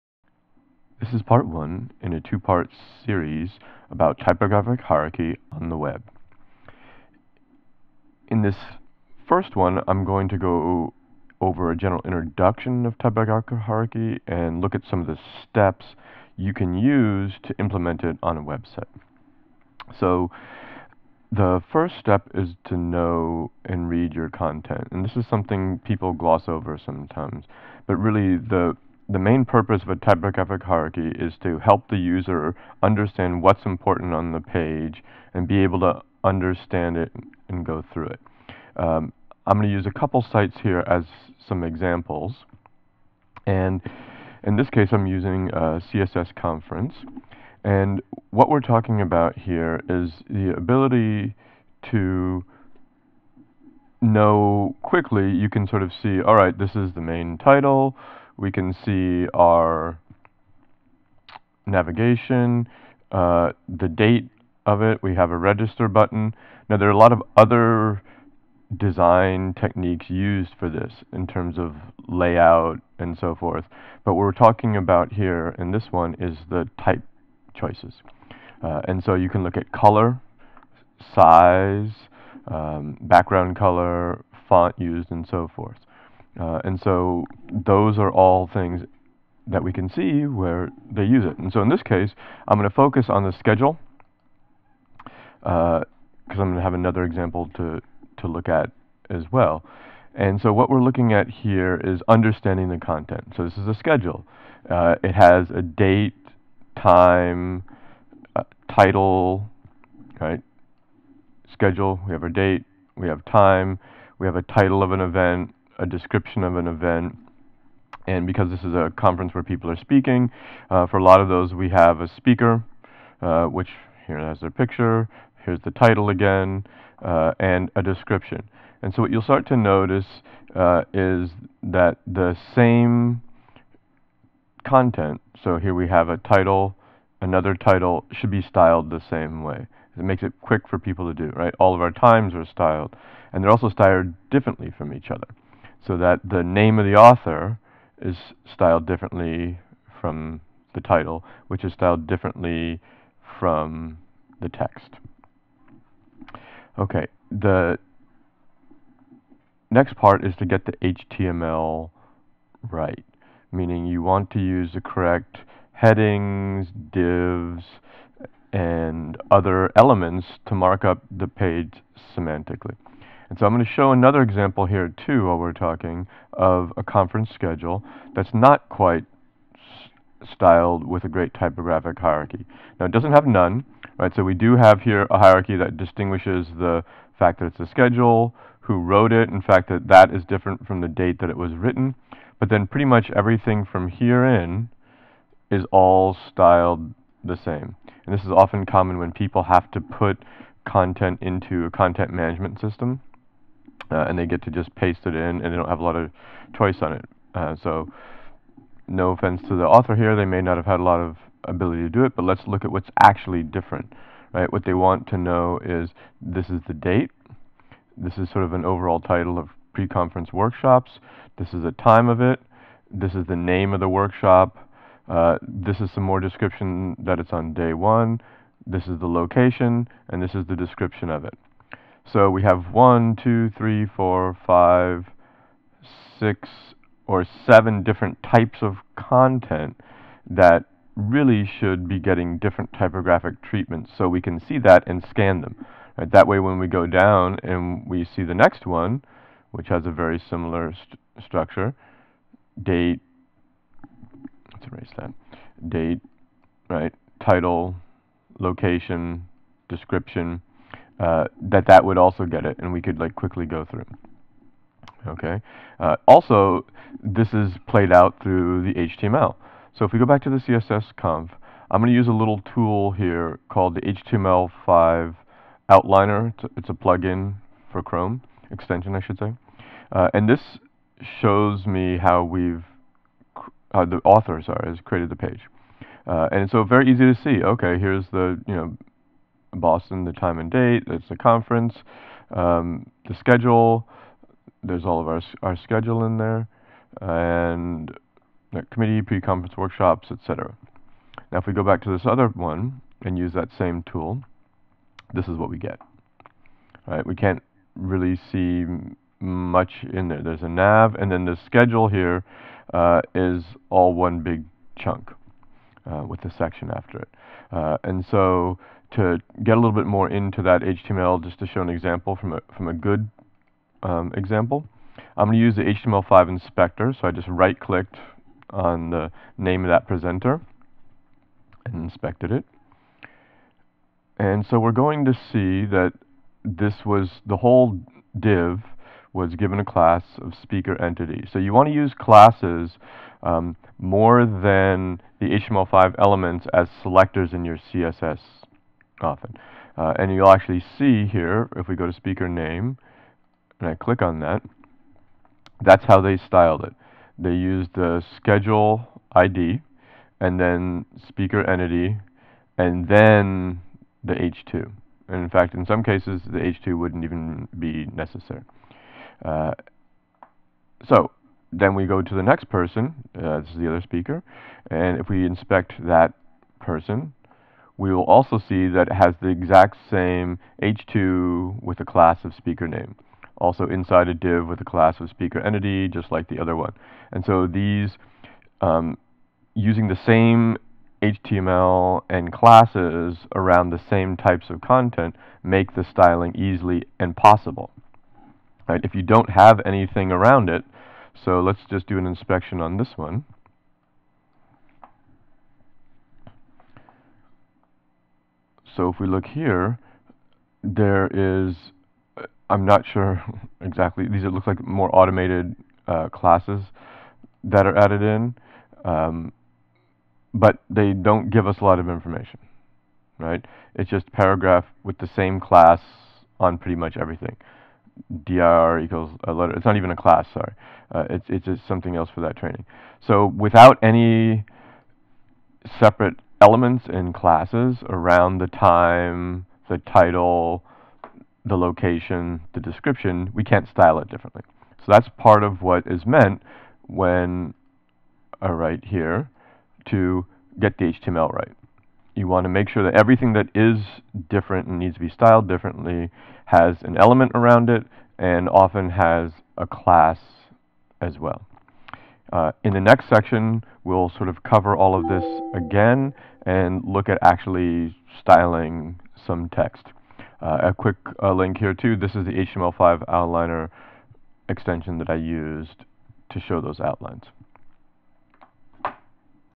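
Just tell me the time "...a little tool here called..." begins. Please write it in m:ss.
4:32.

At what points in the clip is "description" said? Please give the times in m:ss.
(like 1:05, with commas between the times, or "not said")
1:55, 2:07, 3:46, 3:50, 4:19, 7:22.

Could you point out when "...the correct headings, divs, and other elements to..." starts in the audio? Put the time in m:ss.
2:44.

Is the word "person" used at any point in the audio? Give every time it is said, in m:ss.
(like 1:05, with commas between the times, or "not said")
6:12, 6:16.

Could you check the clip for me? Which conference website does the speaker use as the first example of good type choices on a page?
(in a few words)
CSS conference.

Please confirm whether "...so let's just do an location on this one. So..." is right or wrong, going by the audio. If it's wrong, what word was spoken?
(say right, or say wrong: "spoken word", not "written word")
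wrong: "inspection", not "location".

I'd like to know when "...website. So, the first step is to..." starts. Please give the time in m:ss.
0:18.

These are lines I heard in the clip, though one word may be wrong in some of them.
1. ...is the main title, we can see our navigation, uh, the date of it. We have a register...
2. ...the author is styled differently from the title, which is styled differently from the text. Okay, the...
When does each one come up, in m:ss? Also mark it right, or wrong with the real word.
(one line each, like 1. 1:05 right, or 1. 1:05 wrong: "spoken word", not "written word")
1. 0:56 right
2. 2:26 right.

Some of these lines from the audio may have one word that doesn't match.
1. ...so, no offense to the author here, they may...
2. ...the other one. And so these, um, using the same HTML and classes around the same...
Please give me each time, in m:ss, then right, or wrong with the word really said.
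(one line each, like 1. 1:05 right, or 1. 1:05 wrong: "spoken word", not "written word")
1. 3:27 right
2. 6:26 right.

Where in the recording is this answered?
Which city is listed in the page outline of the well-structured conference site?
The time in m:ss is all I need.
4:49.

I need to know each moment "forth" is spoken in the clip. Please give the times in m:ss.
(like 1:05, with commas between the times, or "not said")
1:13, 1:25.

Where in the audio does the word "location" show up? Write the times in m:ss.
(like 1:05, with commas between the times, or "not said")
3:49, 4:18, 7:21.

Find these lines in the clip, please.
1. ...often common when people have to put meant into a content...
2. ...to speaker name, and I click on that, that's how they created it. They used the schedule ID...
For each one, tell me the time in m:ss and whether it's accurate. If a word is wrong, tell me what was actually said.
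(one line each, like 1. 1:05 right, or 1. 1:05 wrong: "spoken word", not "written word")
1. 3:18 wrong: "content", not "meant"
2. 5:51 wrong: "styled", not "created".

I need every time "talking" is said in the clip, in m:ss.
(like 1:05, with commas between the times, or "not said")
0:48, 1:14, 2:55.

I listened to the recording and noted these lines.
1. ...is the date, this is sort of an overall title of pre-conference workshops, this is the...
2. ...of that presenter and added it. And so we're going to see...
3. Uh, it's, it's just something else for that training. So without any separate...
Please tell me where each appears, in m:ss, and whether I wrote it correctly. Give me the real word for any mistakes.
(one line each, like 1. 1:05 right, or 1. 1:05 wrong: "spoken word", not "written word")
1. 3:36 right
2. 5:29 wrong: "inspected", not "added"
3. 7:10 right.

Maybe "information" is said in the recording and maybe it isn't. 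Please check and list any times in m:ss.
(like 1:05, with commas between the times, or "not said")
7:01.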